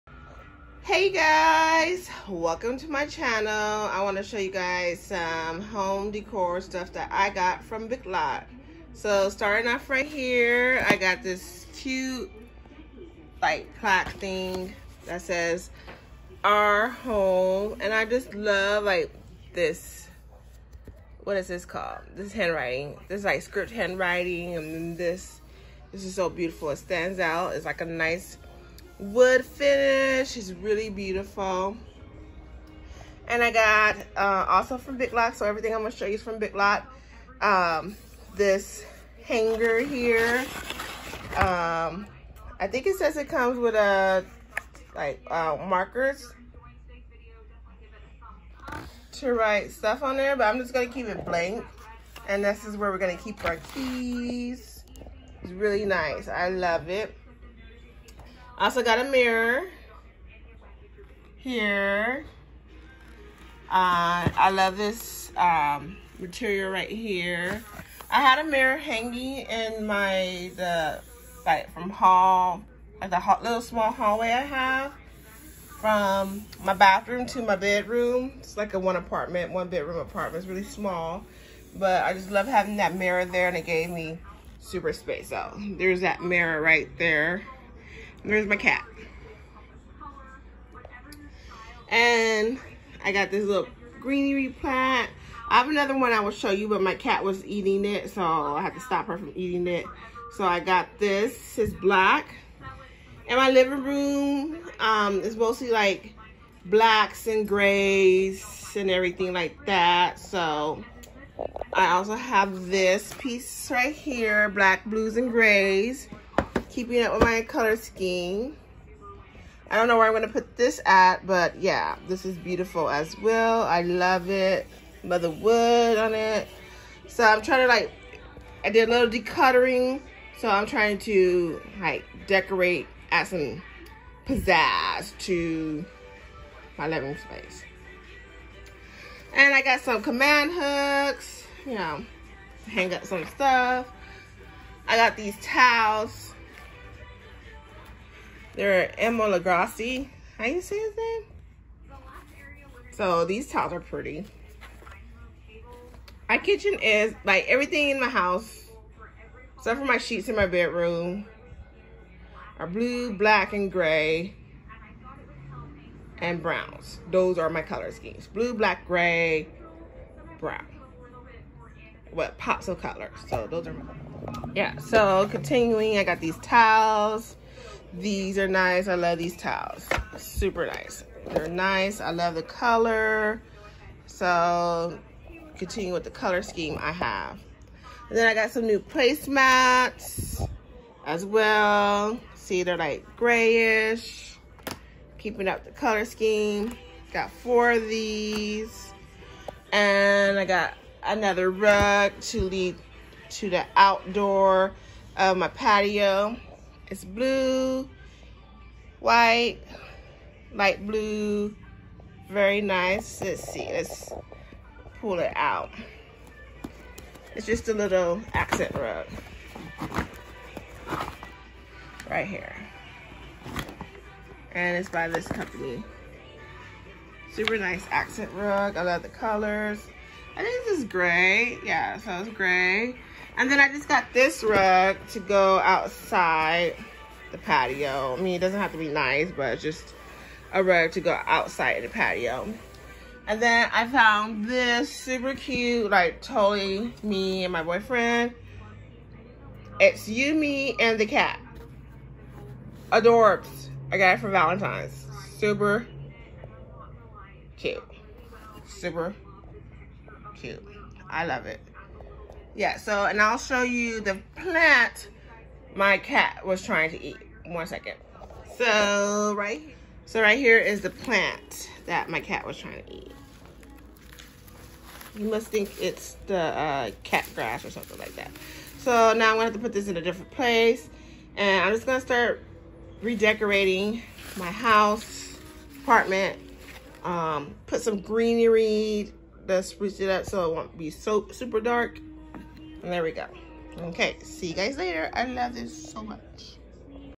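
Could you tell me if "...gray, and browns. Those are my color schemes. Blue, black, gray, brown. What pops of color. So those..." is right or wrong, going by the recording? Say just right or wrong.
right.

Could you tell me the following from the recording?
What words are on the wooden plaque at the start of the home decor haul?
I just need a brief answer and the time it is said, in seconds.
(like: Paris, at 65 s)
Our home, at 16 s.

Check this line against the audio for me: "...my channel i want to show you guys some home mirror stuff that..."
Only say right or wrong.
wrong.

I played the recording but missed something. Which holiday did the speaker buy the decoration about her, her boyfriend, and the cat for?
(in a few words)
Valentine's.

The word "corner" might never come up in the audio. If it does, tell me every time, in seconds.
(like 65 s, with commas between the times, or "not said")
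not said.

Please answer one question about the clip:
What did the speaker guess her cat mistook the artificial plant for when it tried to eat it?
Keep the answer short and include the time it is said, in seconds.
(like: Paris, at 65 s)
Cat grass, at 277 s.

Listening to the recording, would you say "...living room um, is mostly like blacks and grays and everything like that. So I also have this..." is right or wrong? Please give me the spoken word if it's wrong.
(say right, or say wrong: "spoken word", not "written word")
right.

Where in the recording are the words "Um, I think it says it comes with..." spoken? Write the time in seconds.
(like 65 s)
41 s.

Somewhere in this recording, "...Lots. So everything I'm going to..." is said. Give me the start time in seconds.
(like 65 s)
35 s.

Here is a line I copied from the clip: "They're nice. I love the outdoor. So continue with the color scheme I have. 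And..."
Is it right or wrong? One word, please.
wrong.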